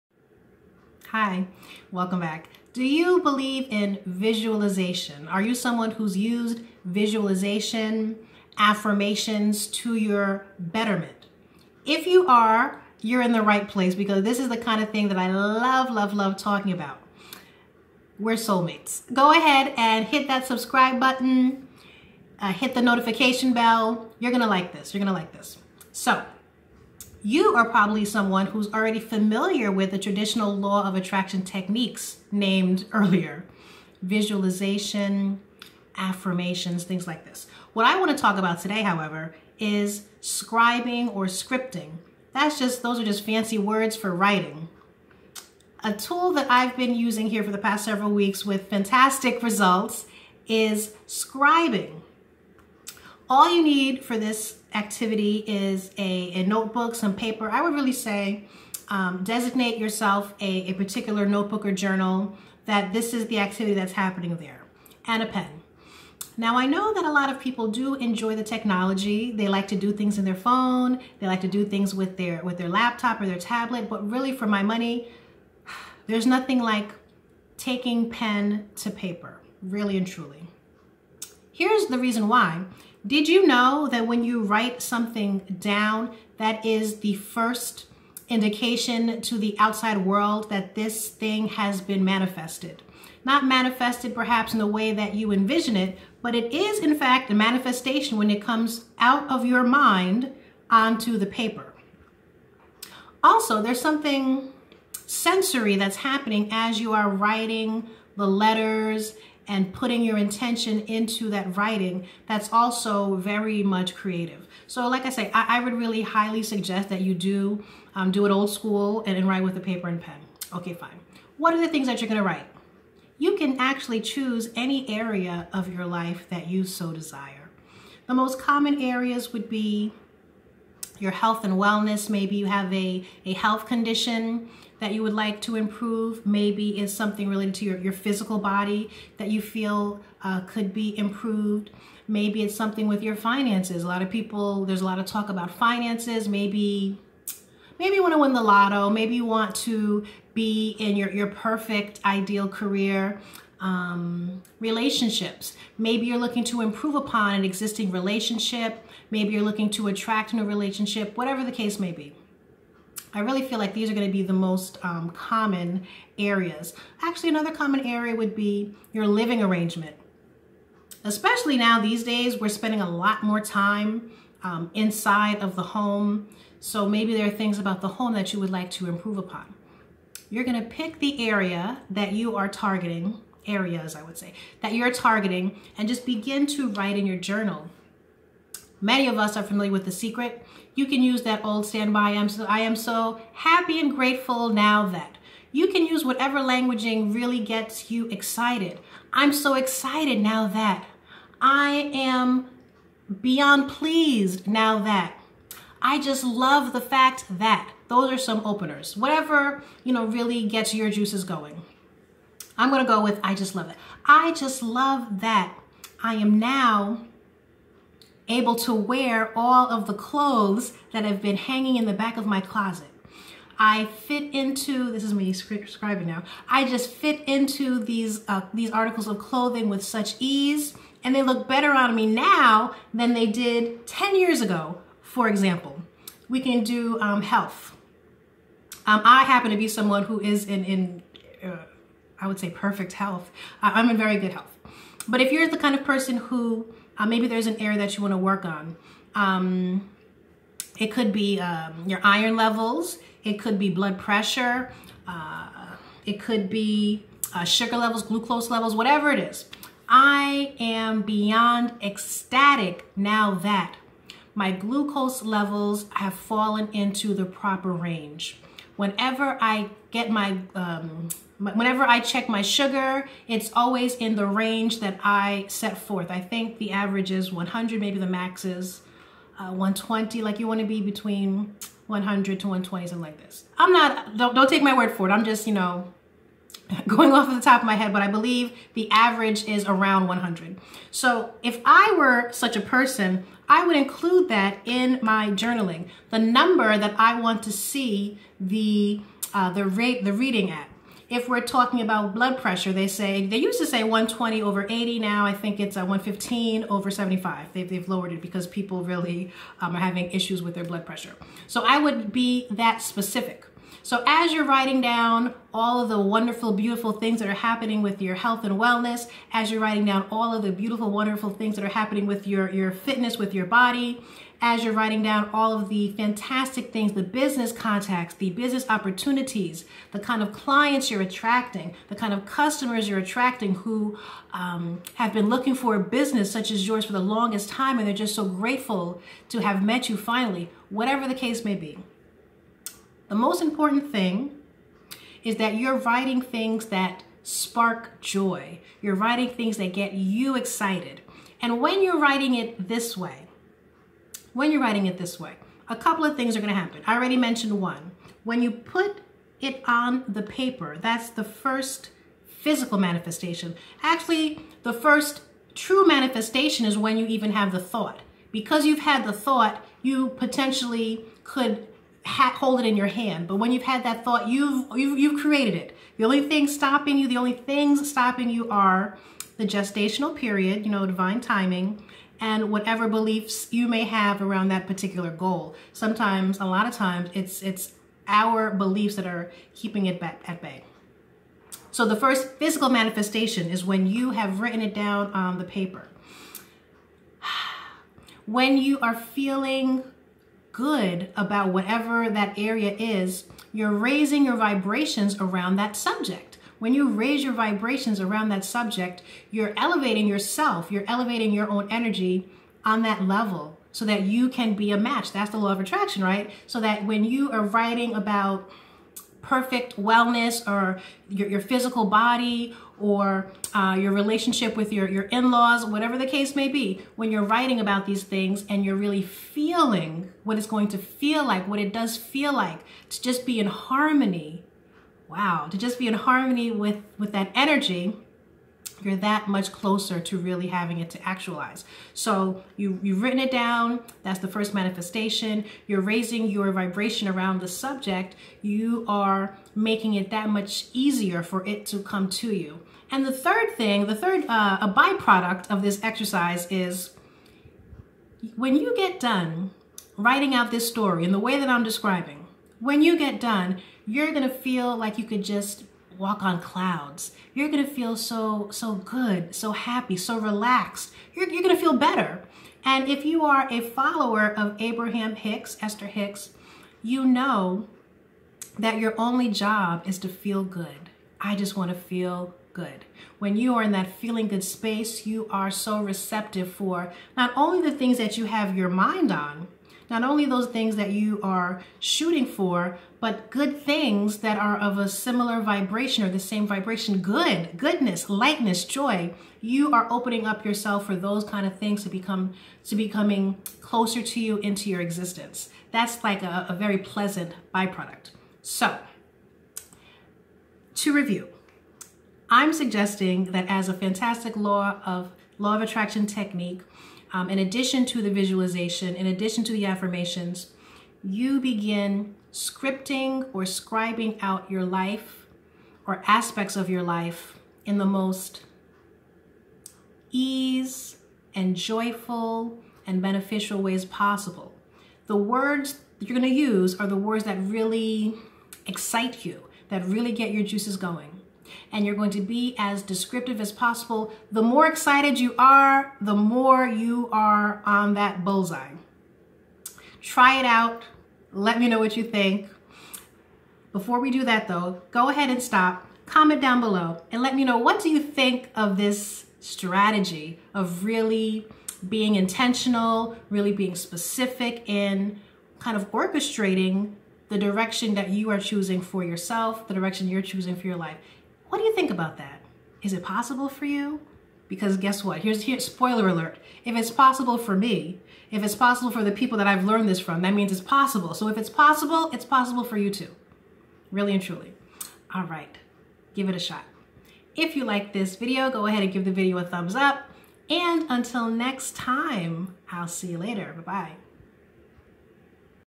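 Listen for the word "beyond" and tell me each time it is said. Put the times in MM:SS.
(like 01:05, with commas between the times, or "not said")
03:23, 04:21.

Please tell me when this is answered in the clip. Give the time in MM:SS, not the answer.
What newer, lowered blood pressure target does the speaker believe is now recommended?
05:05.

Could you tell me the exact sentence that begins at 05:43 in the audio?
The most important thing is that you're writing things that spark joy.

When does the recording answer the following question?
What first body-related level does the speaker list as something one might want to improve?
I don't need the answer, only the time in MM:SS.
04:12.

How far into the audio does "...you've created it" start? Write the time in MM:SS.
06:14.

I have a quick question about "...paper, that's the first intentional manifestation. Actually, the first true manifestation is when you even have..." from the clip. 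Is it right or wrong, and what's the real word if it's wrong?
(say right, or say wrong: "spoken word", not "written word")
wrong: "physical", not "intentional".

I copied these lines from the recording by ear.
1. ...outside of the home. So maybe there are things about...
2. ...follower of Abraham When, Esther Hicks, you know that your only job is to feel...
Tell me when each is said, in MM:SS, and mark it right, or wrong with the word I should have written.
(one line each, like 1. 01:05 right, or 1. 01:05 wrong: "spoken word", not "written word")
1. 02:54 wrong: "inside", not "outside"
2. 07:53 wrong: "Hicks", not "When".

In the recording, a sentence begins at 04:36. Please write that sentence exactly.
I think the average is 100, maybe the max is uh, 120.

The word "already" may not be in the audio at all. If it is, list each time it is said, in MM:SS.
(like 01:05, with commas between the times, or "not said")
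00:28, 05:56.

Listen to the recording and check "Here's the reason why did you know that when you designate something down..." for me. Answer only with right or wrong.
wrong.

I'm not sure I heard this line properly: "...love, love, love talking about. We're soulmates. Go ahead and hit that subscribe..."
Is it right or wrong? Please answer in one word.
right.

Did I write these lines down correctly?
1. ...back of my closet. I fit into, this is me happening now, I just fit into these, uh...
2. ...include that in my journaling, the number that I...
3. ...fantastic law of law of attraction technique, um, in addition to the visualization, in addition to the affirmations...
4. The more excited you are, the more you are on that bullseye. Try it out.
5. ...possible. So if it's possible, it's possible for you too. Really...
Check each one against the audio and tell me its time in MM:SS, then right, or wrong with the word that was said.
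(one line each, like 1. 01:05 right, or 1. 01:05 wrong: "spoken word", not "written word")
1. 03:41 wrong: "scribing", not "happening"
2. 04:53 right
3. 08:33 right
4. 09:04 right
5. 09:40 right.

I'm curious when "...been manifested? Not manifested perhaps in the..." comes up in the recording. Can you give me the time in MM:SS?
01:31.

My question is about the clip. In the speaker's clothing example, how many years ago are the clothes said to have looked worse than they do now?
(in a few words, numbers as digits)
10.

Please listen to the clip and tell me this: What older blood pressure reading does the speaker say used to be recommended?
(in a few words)
120 over 80.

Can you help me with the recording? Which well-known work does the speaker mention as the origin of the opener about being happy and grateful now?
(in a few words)
The Secret.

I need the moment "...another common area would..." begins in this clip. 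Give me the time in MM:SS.
02:47.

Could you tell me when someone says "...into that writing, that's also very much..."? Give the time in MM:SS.
01:50.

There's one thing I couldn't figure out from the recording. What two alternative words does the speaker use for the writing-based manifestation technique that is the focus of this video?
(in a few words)
scribing or scripting.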